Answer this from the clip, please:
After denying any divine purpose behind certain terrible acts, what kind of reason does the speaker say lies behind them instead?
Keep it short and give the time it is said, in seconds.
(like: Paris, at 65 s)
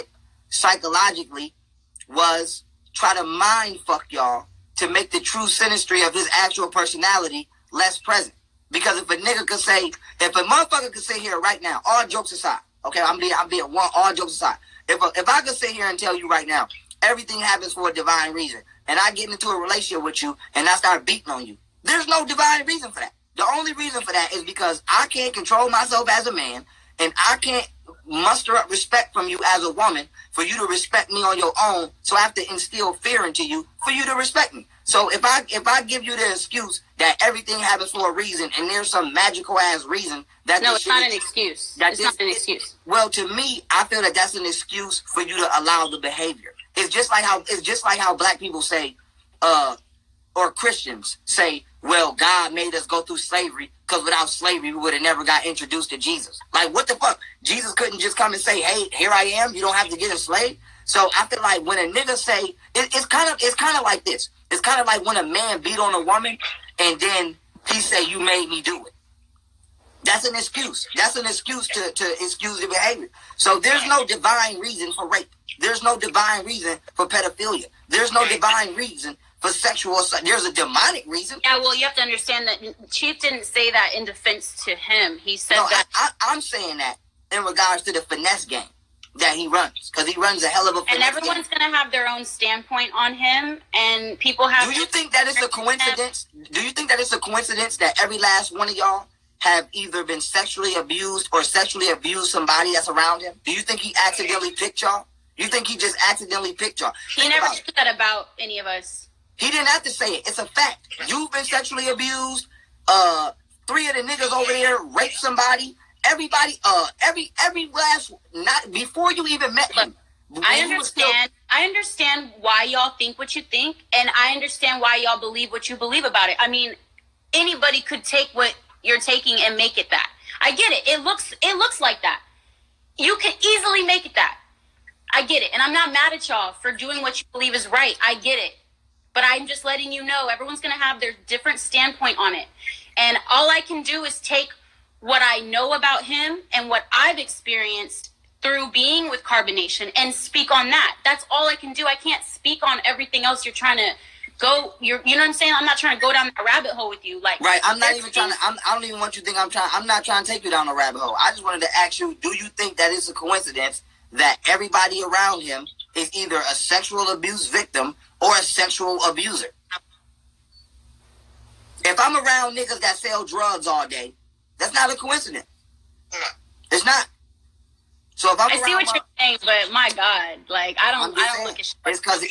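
demonic, at 80 s.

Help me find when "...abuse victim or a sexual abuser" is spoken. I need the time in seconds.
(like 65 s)
167 s.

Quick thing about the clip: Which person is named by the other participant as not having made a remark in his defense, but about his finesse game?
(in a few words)
Chief.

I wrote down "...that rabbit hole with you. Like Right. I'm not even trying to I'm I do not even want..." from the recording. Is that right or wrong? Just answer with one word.
right.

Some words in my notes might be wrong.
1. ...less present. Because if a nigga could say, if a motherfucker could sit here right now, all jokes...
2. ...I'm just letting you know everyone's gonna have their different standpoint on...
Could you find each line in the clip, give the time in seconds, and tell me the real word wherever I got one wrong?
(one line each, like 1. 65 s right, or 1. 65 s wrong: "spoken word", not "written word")
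1. 7 s right
2. 139 s right.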